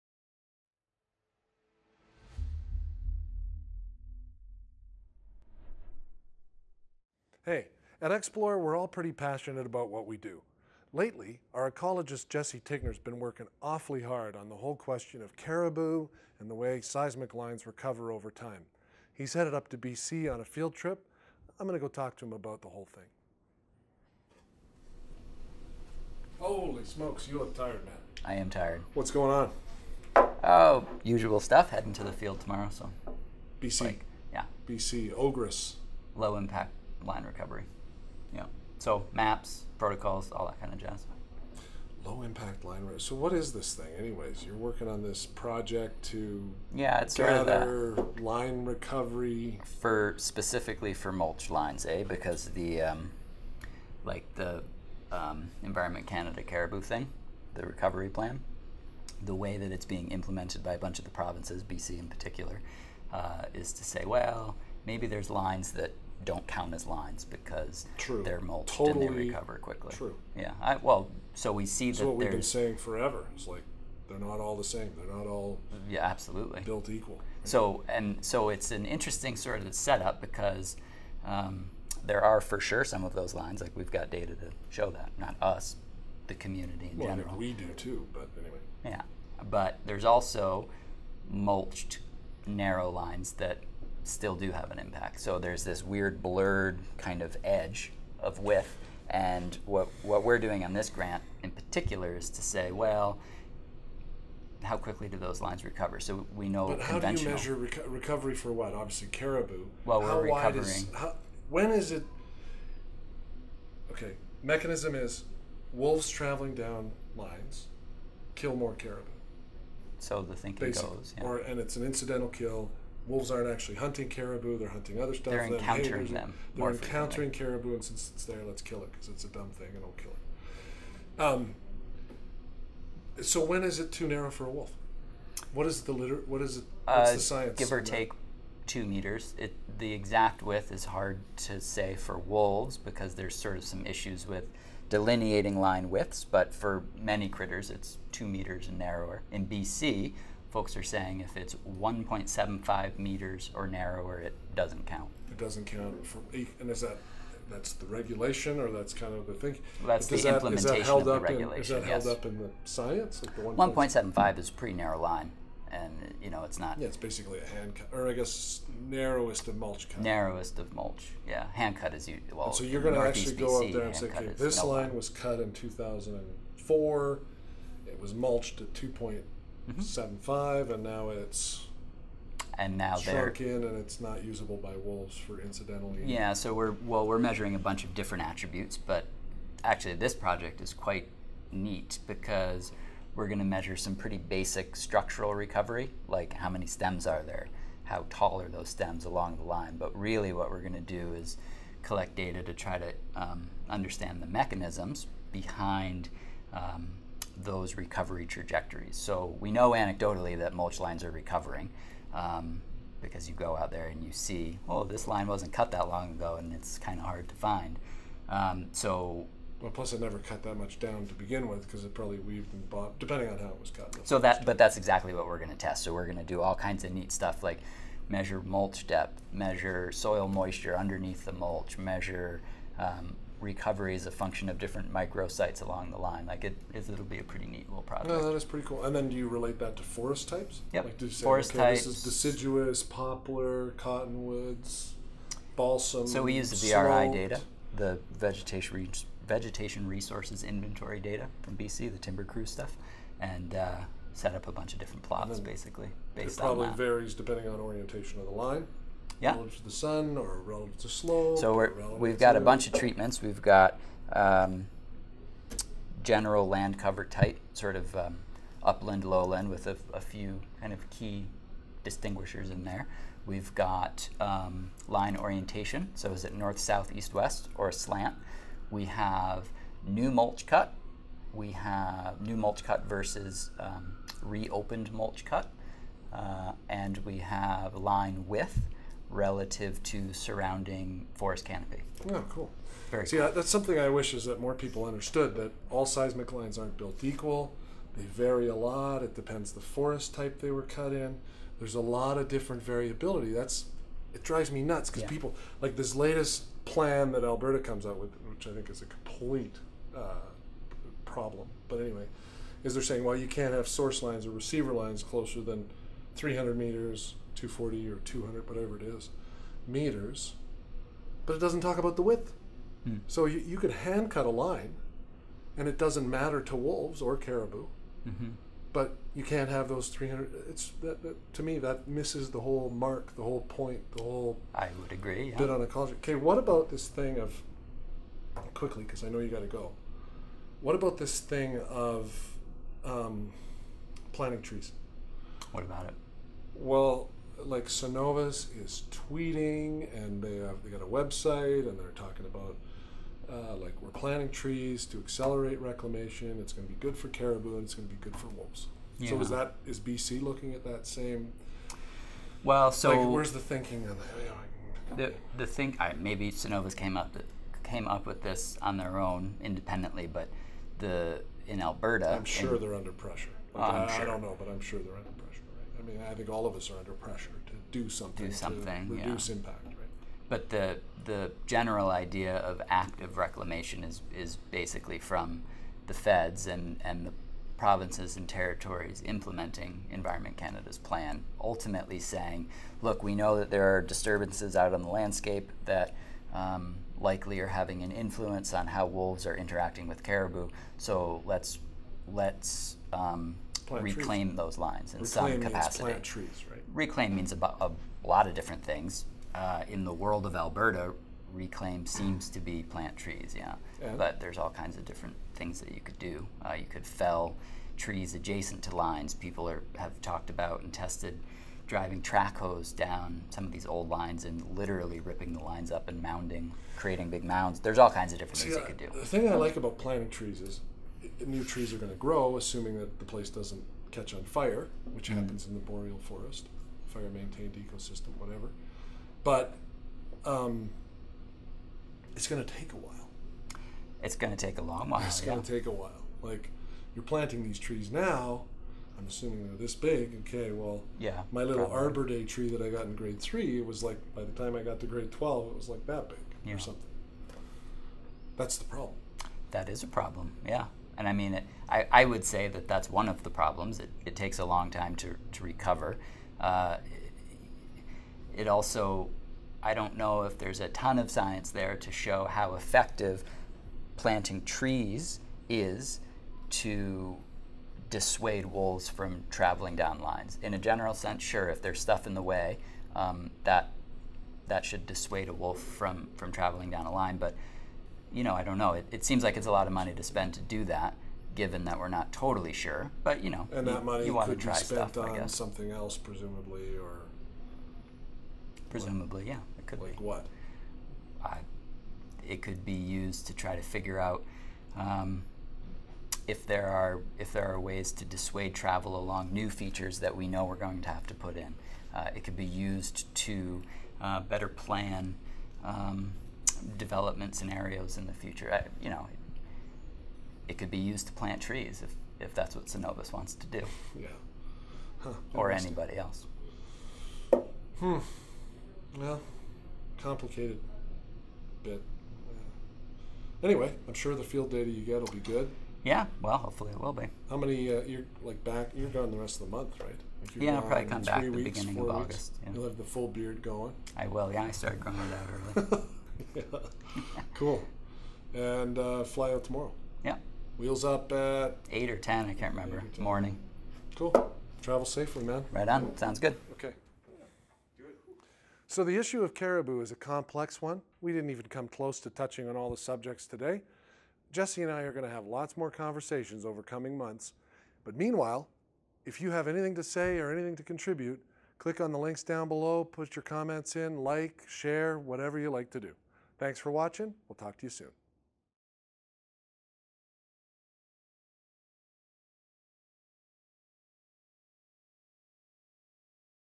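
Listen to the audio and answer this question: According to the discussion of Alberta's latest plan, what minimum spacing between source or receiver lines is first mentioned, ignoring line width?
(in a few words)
300 meters.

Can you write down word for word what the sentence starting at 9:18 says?
So the issue of caribou is a complex one.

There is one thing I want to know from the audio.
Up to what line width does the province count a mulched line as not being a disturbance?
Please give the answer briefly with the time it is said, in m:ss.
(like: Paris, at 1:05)
1.75 meters, at 2:31.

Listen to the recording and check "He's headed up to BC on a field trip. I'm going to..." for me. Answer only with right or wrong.
right.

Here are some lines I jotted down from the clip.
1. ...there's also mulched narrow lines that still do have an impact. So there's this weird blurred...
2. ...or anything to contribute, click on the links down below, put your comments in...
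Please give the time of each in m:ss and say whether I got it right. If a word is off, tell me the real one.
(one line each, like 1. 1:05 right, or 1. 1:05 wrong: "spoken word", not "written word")
1. 1:29 right
2. 9:30 right.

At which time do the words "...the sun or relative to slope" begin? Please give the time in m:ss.
4:19.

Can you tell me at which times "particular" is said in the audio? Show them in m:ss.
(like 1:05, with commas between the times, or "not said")
1:02, 1:41.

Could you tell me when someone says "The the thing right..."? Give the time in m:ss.
6:04.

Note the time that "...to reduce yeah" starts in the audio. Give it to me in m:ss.
6:18.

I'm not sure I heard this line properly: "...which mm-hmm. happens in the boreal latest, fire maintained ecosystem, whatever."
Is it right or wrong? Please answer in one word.
wrong.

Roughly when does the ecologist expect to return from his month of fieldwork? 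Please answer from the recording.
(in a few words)
beginning of August.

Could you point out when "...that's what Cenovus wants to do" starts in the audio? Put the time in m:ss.
8:42.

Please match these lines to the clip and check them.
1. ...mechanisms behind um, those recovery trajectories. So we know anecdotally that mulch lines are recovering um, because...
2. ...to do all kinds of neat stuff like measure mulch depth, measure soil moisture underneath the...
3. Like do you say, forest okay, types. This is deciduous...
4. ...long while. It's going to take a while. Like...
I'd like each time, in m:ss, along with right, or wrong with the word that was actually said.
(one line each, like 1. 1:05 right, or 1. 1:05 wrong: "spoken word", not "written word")
1. 3:24 right
2. 3:46 right
3. 4:00 right
4. 7:24 right.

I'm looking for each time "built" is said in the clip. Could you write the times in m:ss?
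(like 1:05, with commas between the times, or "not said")
1:16, 4:56.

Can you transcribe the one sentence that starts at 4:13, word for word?
Uh, set up a bunch of different plots, basically.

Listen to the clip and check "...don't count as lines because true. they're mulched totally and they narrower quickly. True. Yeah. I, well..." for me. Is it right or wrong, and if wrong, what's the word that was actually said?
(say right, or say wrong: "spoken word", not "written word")
wrong: "recover", not "narrower".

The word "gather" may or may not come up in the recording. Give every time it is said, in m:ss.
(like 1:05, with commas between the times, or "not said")
0:47.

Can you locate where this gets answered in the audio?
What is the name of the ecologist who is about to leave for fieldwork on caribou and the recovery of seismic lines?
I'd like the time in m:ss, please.
0:12.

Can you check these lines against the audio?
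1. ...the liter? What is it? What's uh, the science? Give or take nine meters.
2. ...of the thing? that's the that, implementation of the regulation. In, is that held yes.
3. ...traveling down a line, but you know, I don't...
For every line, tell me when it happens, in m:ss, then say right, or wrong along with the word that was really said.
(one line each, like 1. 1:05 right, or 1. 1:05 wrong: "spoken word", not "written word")
1. 2:15 wrong: "two", not "nine"
2. 2:39 right
3. 8:06 right.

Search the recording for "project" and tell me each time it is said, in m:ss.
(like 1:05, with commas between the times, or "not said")
0:45, 3:10, 3:57.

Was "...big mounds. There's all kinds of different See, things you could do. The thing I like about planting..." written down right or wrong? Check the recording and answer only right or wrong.
right.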